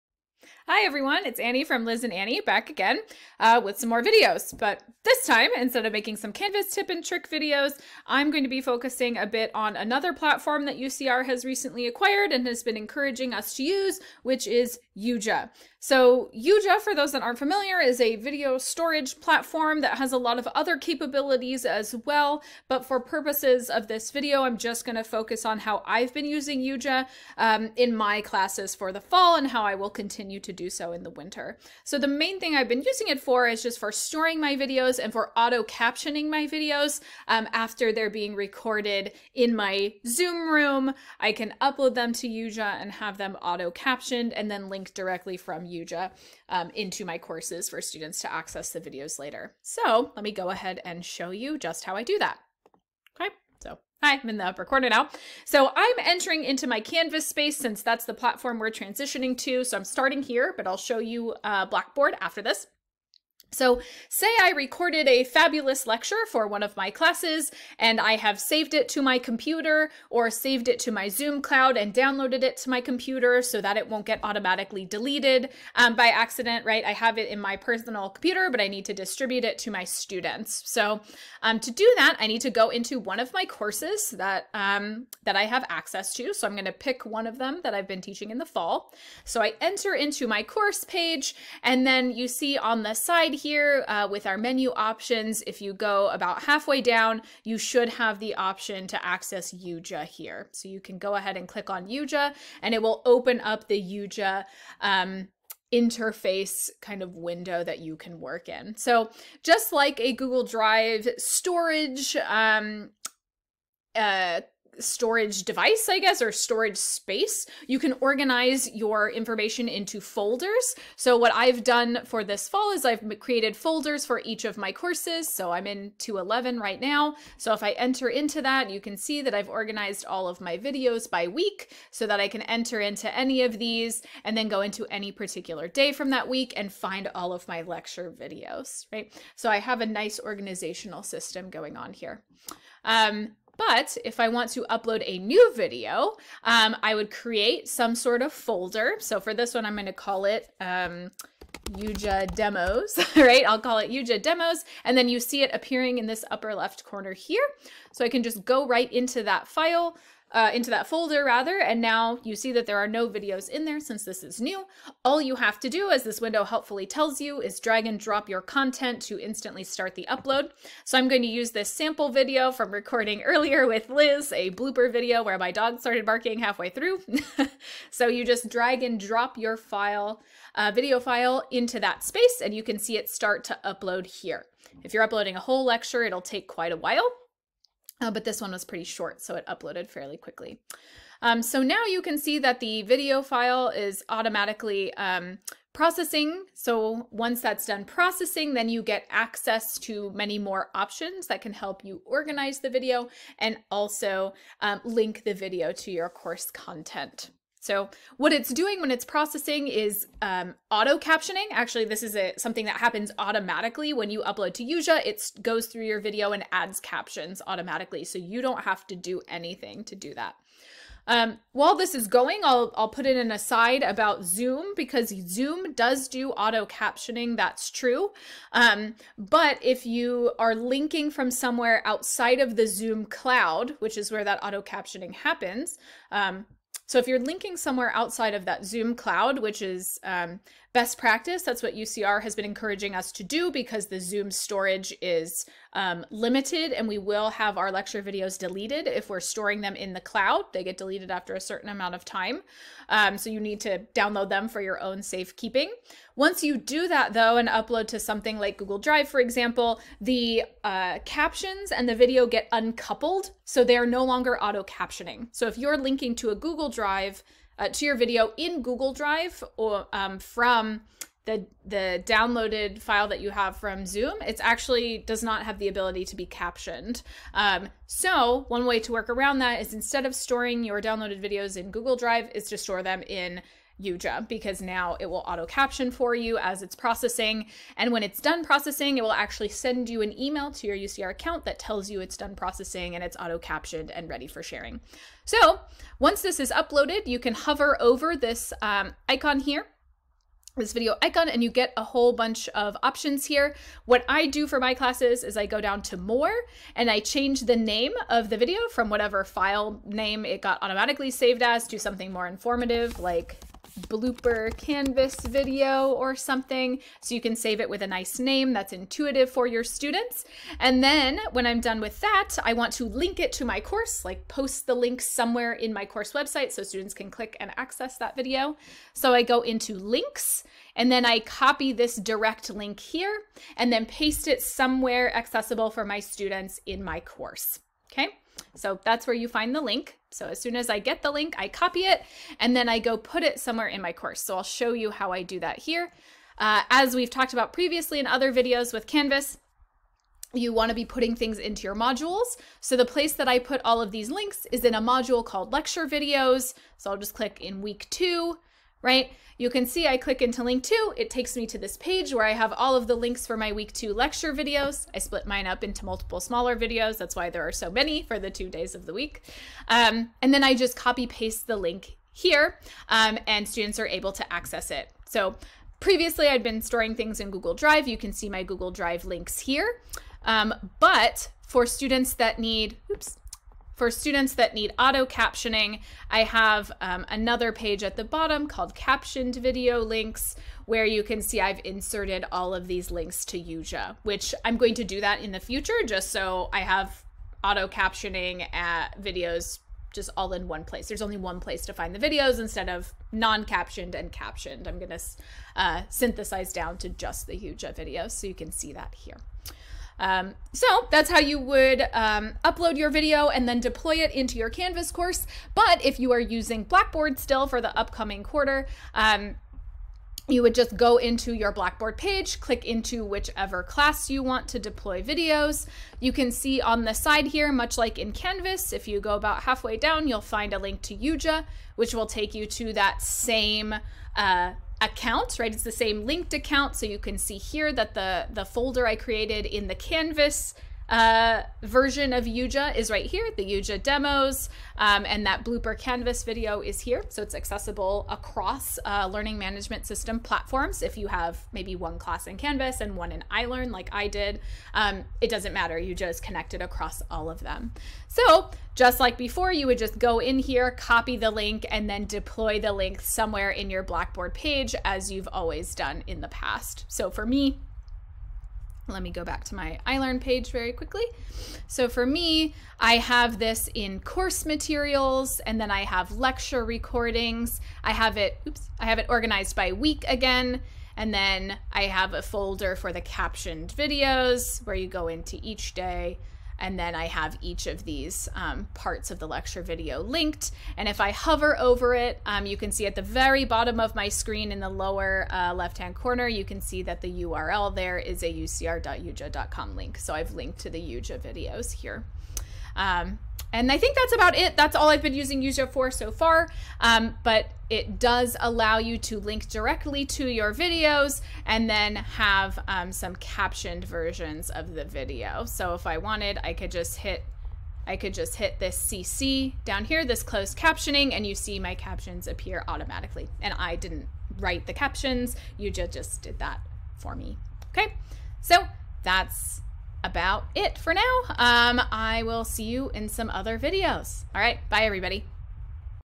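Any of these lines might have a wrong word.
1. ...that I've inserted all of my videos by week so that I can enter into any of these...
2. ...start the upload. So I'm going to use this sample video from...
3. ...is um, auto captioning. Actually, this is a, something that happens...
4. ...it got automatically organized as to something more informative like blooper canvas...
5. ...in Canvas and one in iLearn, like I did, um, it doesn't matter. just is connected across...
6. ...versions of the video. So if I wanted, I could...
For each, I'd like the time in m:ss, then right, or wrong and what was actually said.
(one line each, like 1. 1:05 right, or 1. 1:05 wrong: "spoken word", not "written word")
1. 2:09 wrong: "organized", not "inserted"
2. 2:49 right
3. 3:29 right
4. 5:10 wrong: "saved", not "organized"
5. 7:32 right
6. 8:33 right.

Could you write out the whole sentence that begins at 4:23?
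So they are no longer auto captioning.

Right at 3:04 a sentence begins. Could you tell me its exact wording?
If you're uploading a whole lecture, it'll take quite a while.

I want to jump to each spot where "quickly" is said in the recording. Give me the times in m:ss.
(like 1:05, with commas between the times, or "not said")
3:10, 7:50.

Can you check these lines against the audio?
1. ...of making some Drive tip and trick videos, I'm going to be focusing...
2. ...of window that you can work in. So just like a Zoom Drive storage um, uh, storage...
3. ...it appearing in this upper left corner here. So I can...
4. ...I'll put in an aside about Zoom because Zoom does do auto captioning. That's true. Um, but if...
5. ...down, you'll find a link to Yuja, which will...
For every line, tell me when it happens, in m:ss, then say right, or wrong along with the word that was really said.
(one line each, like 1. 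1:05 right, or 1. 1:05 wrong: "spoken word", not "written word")
1. 0:05 wrong: "Canvas", not "Drive"
2. 1:47 wrong: "Google", not "Zoom"
3. 2:35 right
4. 3:42 right
5. 7:09 right.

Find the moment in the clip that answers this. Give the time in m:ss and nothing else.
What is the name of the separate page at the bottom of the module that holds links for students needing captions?
6:28.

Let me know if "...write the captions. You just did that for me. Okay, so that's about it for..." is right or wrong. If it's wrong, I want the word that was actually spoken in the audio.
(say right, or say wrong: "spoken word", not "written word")
right.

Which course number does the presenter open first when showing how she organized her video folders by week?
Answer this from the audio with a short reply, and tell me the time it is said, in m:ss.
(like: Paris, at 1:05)
211, at 2:05.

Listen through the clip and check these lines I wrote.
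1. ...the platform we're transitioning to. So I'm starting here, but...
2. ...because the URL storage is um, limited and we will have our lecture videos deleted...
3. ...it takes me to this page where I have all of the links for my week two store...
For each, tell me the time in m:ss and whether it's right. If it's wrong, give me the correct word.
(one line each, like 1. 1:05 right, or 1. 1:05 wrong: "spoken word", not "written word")
1. 0:58 right
2. 4:03 wrong: "Zoom", not "URL"
3. 6:00 wrong: "lecture", not "store".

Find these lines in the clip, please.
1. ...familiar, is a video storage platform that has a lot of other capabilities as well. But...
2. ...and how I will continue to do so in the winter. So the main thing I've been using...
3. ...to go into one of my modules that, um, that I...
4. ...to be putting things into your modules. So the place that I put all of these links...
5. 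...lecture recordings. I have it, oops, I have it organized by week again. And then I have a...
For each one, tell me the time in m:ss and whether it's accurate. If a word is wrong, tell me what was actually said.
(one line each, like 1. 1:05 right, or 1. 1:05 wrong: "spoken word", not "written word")
1. 0:17 right
2. 0:29 right
3. 1:22 wrong: "courses", not "modules"
4. 5:50 right
5. 7:56 right.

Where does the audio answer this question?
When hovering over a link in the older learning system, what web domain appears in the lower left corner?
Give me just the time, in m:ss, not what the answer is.
8:18.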